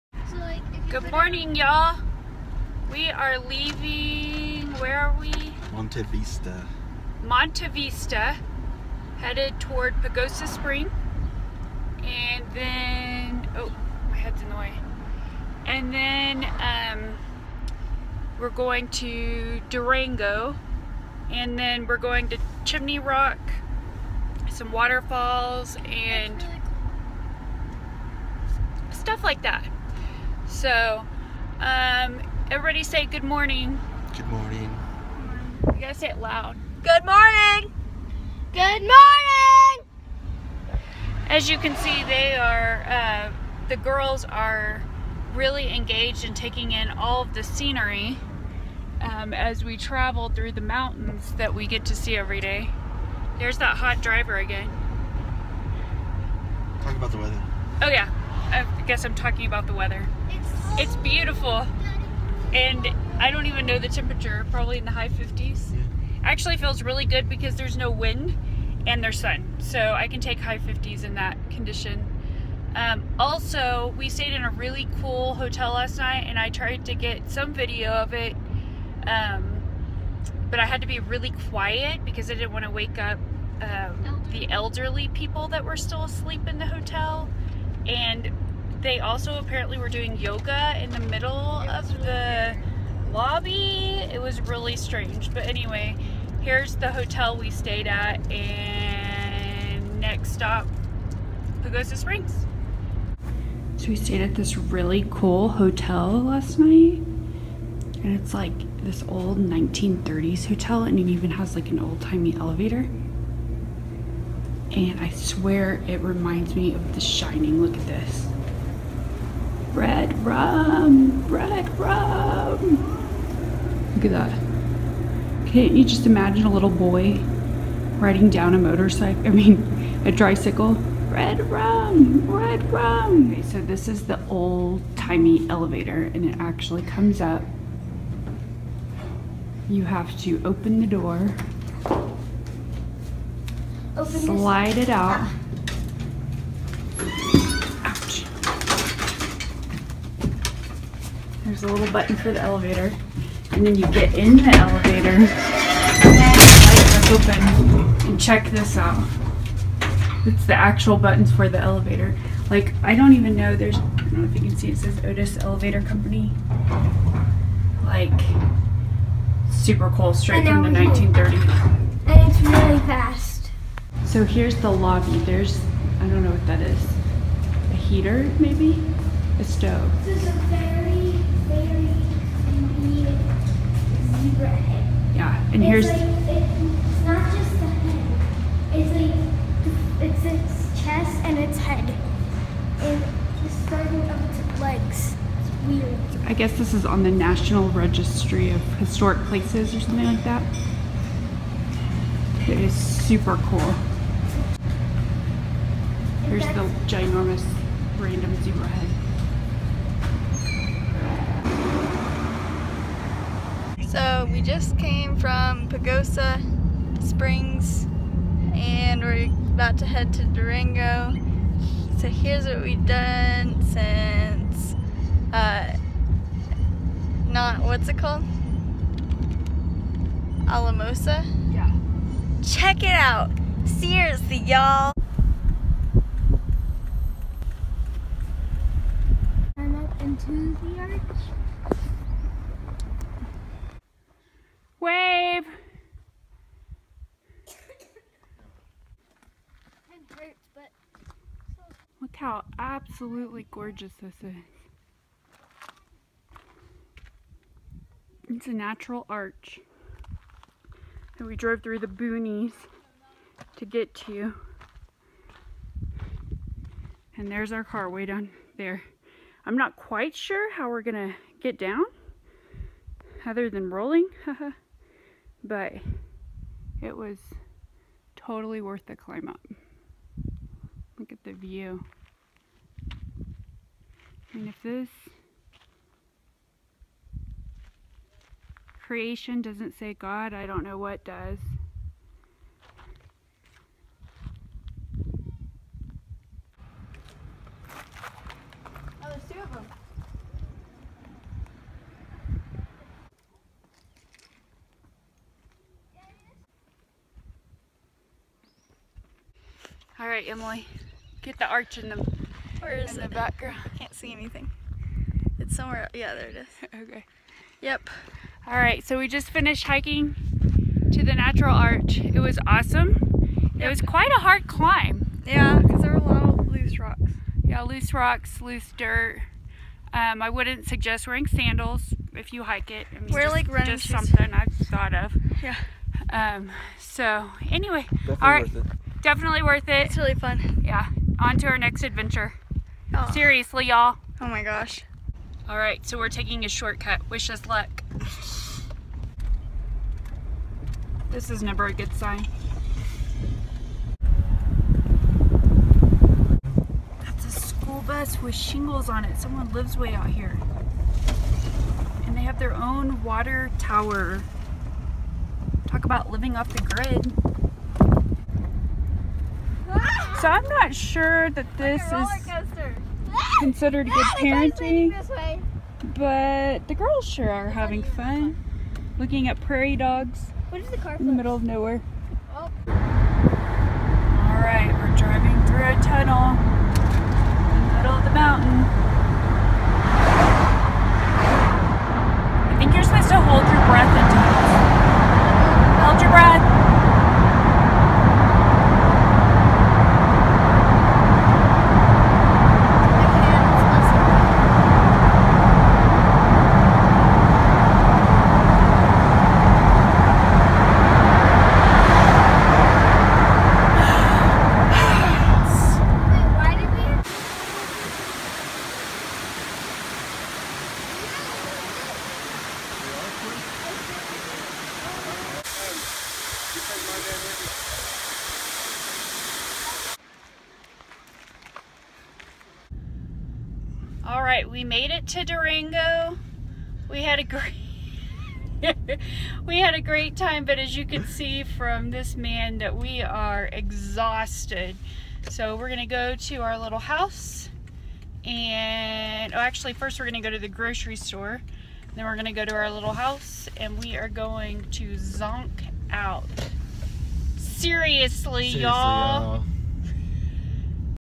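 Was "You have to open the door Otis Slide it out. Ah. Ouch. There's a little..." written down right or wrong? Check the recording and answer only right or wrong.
wrong.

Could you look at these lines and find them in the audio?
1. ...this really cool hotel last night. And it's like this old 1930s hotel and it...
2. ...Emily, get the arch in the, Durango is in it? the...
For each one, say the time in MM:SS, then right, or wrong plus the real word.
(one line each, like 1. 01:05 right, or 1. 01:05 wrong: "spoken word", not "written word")
1. 01:44 right
2. 05:10 wrong: "Where", not "Durango".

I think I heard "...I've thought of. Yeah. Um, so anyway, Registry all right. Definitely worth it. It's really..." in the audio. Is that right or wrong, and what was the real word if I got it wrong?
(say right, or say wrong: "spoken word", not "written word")
wrong: "Definitely", not "Registry".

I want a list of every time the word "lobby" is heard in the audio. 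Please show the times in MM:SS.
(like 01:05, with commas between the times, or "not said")
01:33, 02:54.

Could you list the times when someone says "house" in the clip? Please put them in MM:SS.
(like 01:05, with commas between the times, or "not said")
07:26, 07:32.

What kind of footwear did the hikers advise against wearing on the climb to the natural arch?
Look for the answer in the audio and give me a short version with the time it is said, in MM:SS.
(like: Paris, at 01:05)
Sandals, at 05:31.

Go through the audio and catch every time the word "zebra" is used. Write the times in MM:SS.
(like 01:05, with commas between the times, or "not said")
03:04, 03:28.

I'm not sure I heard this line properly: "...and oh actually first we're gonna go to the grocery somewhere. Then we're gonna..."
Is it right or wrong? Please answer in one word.
wrong.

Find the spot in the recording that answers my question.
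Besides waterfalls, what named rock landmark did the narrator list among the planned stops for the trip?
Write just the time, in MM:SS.
00:22.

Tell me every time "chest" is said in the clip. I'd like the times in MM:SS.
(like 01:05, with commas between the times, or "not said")
03:10.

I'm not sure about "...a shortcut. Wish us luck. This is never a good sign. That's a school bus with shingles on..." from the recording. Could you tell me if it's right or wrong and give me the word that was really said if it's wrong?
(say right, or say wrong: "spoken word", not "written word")
right.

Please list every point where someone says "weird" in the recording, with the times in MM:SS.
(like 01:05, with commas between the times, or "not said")
03:15.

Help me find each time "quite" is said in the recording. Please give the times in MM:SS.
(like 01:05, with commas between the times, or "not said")
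04:29, 05:23.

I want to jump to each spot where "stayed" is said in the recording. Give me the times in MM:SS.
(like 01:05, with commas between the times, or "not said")
01:14, 01:37, 01:43.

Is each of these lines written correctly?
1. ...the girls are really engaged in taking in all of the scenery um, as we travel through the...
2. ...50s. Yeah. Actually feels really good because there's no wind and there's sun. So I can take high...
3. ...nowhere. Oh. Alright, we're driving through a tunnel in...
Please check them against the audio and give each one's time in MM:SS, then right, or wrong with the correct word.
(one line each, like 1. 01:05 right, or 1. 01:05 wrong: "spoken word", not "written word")
1. 00:43 right
2. 01:05 right
3. 06:21 right.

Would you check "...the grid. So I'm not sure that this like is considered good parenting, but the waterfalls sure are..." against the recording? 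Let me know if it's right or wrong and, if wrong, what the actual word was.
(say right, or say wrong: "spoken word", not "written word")
wrong: "girls", not "waterfalls".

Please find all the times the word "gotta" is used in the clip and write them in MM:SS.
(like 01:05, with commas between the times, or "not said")
00:35.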